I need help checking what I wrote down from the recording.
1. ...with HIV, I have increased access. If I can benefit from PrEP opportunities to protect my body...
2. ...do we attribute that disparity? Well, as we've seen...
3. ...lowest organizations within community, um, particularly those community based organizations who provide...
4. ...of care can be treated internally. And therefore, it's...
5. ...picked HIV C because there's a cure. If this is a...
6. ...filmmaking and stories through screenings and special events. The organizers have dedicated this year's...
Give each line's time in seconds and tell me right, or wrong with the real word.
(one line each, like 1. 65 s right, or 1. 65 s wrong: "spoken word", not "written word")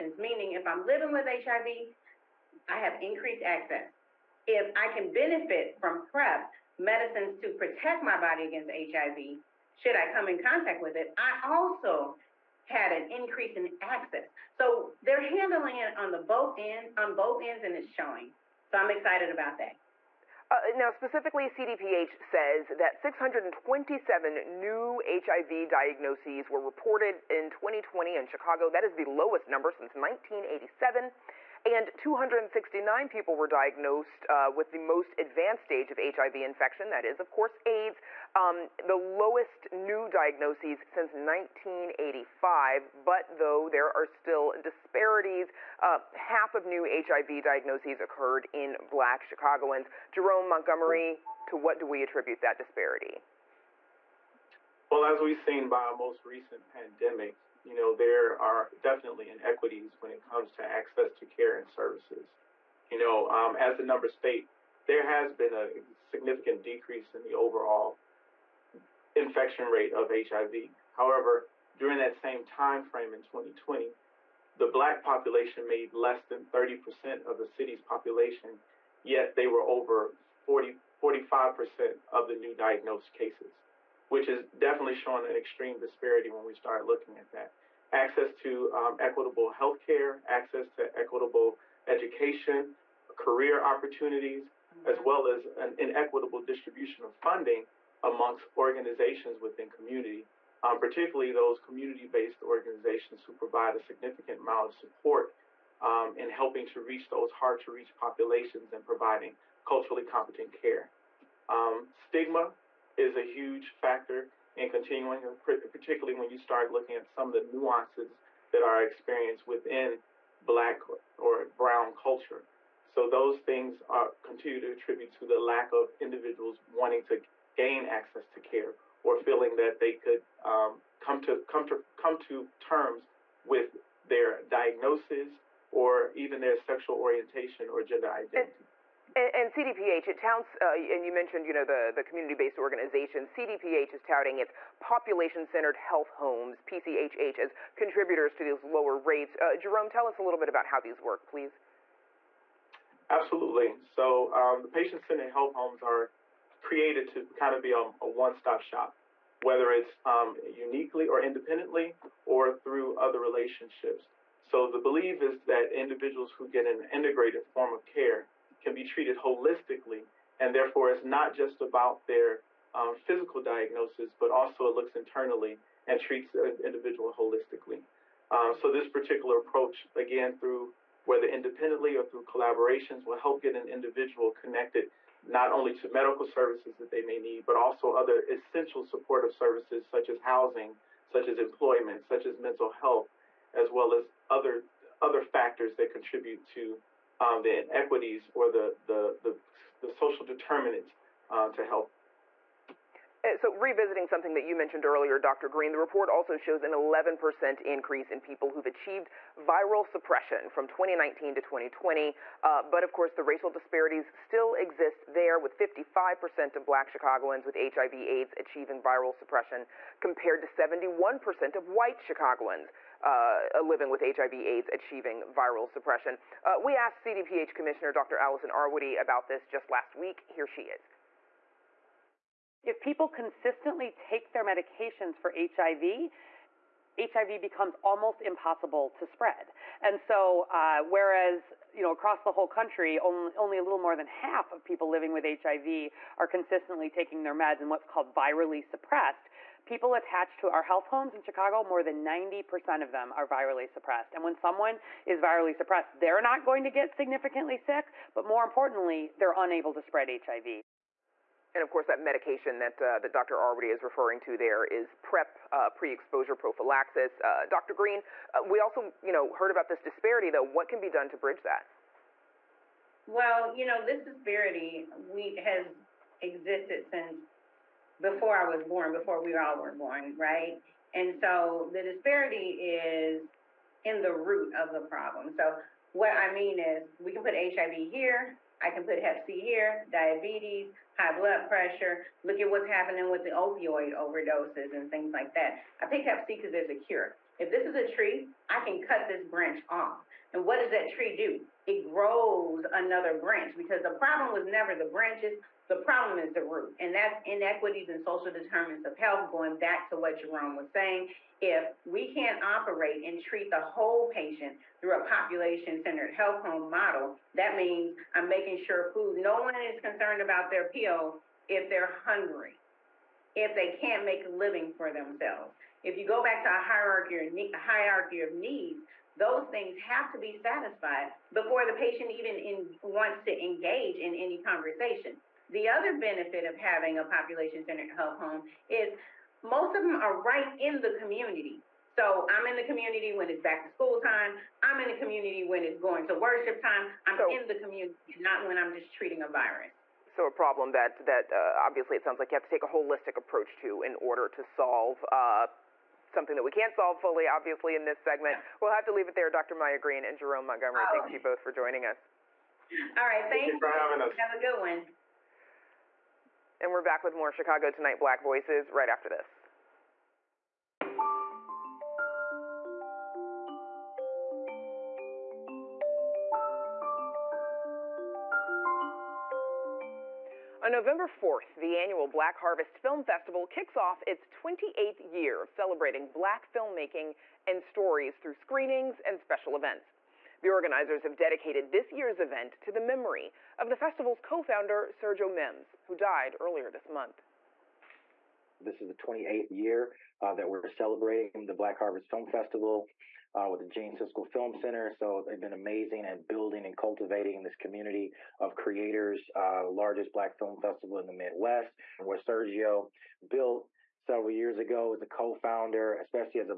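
1. 1 s wrong: "medicines", not "opportunities"
2. 51 s right
3. 98 s wrong: "amongst", not "lowest"
4. 167 s wrong: "holistically", not "internally"
5. 295 s wrong: "Hep", not "HIV"
6. 386 s right.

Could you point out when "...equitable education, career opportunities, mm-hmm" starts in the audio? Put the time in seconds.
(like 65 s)
90 s.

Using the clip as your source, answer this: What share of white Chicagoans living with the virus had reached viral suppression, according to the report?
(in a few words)
71%.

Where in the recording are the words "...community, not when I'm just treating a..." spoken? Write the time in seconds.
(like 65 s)
347 s.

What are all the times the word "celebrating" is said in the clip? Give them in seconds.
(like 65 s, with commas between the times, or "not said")
385 s, 400 s.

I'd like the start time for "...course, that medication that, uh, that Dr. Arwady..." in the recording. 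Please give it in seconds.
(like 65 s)
261 s.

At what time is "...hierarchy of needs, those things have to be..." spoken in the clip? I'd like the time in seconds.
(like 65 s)
327 s.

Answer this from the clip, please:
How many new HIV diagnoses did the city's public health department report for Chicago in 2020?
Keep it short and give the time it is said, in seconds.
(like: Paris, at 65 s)
627, at 22 s.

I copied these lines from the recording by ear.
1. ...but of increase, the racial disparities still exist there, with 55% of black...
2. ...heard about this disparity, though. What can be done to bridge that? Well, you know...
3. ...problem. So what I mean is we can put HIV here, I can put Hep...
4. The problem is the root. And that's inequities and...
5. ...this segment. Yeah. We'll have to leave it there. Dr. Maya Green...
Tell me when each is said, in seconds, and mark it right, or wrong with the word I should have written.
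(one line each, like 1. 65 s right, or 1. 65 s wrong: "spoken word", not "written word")
1. 212 s wrong: "course", not "increase"
2. 269 s right
3. 284 s right
4. 305 s right
5. 357 s right.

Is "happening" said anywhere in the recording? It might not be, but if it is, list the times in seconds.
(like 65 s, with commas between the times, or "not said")
292 s.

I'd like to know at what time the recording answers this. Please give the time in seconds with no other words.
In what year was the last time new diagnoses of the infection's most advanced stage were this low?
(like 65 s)
40 s.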